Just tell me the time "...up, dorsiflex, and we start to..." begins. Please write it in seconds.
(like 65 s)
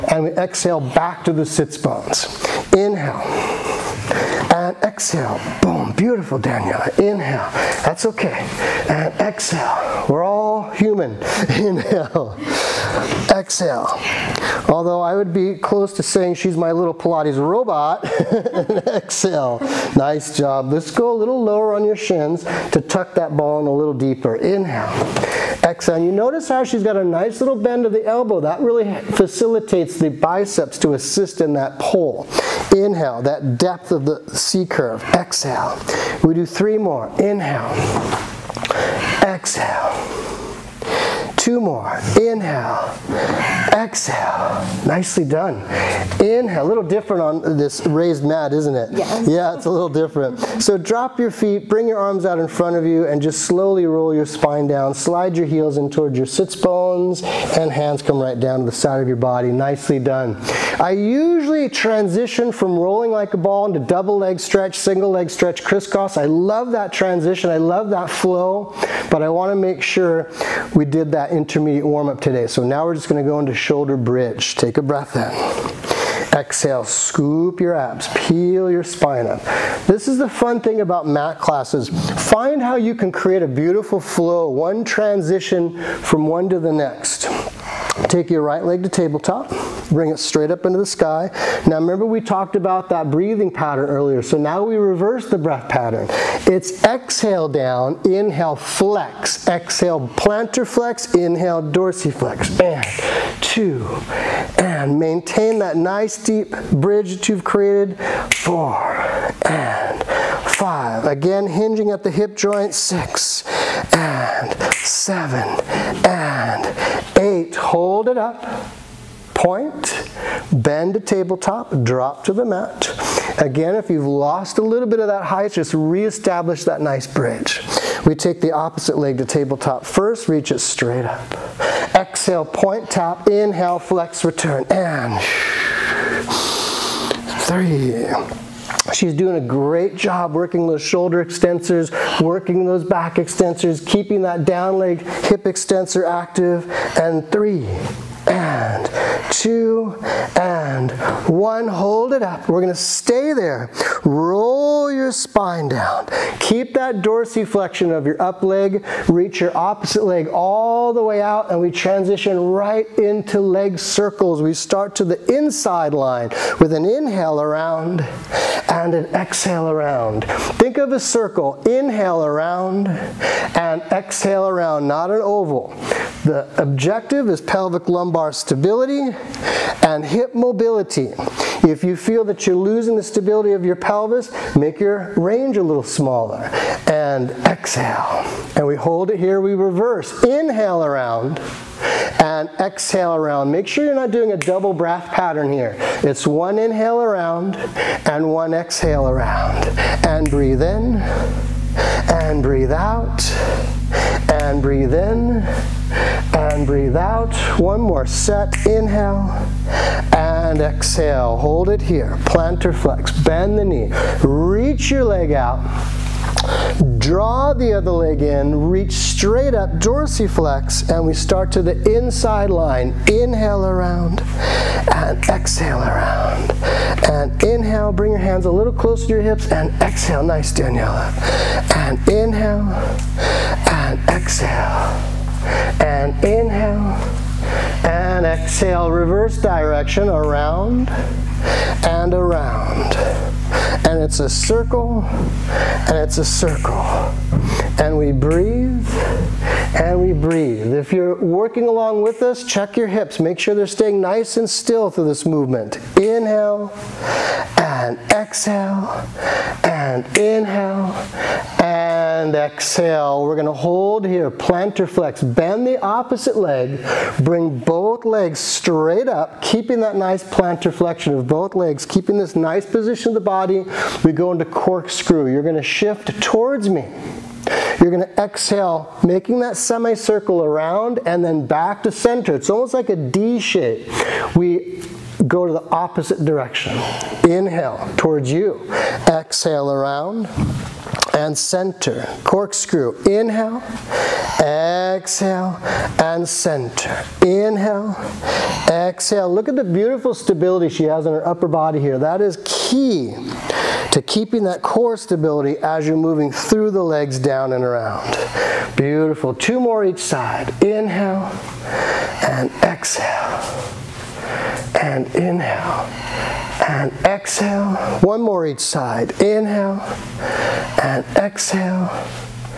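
219 s.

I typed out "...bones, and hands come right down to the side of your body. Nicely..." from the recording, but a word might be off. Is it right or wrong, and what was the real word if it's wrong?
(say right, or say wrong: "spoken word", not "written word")
right.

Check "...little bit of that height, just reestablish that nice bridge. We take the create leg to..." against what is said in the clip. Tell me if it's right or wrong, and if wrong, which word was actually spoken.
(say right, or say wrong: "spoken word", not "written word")
wrong: "opposite", not "create".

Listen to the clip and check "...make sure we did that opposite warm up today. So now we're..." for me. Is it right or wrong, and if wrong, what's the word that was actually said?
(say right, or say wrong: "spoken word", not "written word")
wrong: "intermediate", not "opposite".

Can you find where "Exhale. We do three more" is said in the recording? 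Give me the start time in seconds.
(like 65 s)
35 s.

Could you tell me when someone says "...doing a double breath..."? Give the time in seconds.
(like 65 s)
194 s.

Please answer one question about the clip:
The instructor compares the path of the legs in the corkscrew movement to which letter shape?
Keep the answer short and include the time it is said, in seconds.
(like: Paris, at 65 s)
D, at 282 s.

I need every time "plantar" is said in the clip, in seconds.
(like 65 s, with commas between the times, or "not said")
100 s, 212 s, 264 s, 270 s.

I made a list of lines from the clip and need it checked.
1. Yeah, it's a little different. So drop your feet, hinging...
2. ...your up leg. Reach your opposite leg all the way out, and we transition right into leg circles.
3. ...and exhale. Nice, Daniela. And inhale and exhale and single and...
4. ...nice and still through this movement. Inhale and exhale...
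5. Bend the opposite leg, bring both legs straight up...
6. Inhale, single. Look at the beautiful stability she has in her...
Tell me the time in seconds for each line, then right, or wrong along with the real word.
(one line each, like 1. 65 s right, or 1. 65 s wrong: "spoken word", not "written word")
1. 49 s wrong: "bring", not "hinging"
2. 158 s right
3. 229 s wrong: "inhale", not "single"
4. 253 s right
5. 265 s right
6. 297 s wrong: "exhale", not "single".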